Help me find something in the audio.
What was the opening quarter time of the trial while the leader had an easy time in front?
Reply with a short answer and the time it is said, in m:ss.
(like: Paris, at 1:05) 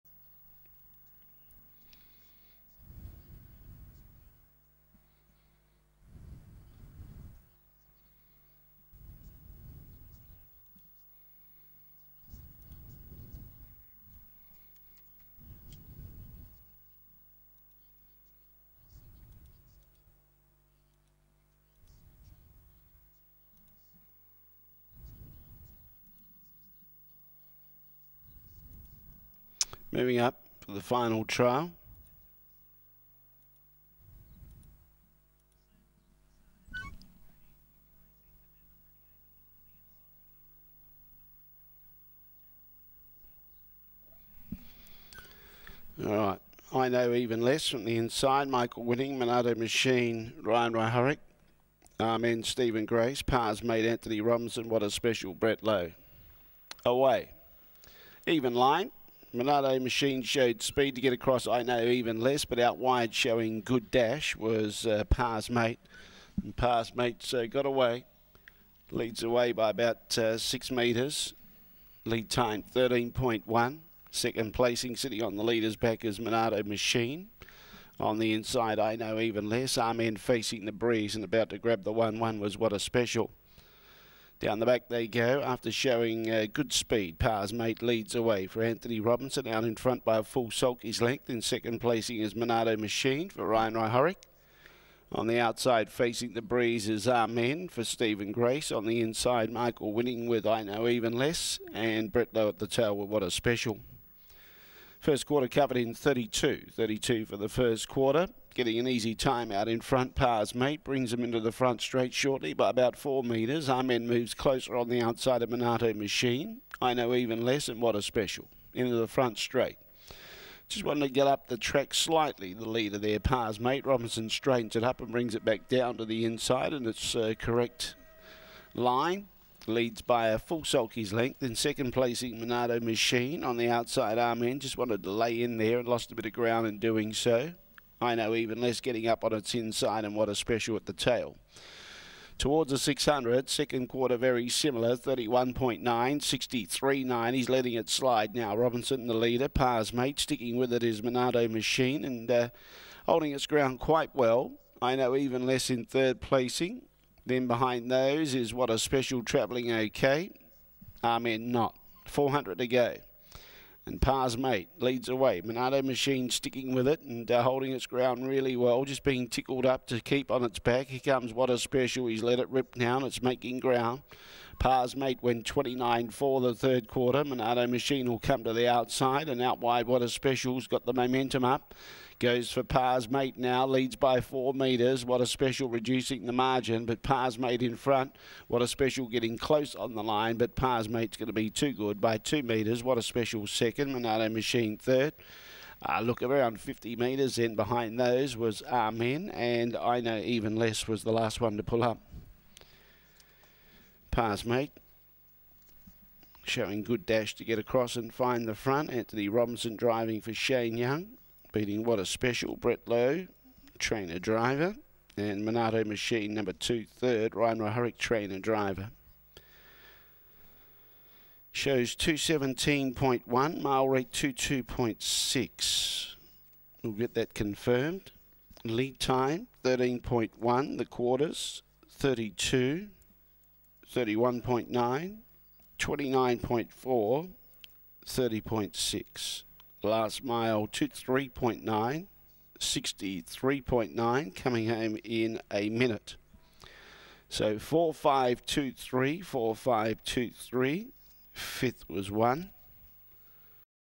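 32, at 1:44.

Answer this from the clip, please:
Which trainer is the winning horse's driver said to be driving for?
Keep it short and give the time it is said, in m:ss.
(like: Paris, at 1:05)
Shane Young, at 3:30.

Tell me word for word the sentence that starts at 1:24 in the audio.
Down the back they go after showing uh, good speed.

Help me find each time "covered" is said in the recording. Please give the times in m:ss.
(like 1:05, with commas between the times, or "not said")
1:45.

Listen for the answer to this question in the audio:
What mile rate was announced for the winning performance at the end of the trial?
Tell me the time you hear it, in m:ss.
3:43.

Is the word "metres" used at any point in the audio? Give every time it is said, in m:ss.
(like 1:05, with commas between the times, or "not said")
1:10, 1:53, 3:04, 3:12, 3:16.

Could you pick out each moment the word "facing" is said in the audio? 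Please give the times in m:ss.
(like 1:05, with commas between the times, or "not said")
1:20, 1:35.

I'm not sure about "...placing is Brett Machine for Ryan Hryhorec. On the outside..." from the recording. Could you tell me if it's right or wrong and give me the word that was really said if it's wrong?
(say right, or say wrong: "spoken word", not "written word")
wrong: "Monado", not "Brett".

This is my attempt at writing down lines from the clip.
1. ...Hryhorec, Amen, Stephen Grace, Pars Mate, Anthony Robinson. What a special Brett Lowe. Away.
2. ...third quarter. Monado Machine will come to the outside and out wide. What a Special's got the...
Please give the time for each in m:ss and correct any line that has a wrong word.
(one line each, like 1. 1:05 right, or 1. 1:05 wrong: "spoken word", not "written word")
1. 0:50 right
2. 2:56 right.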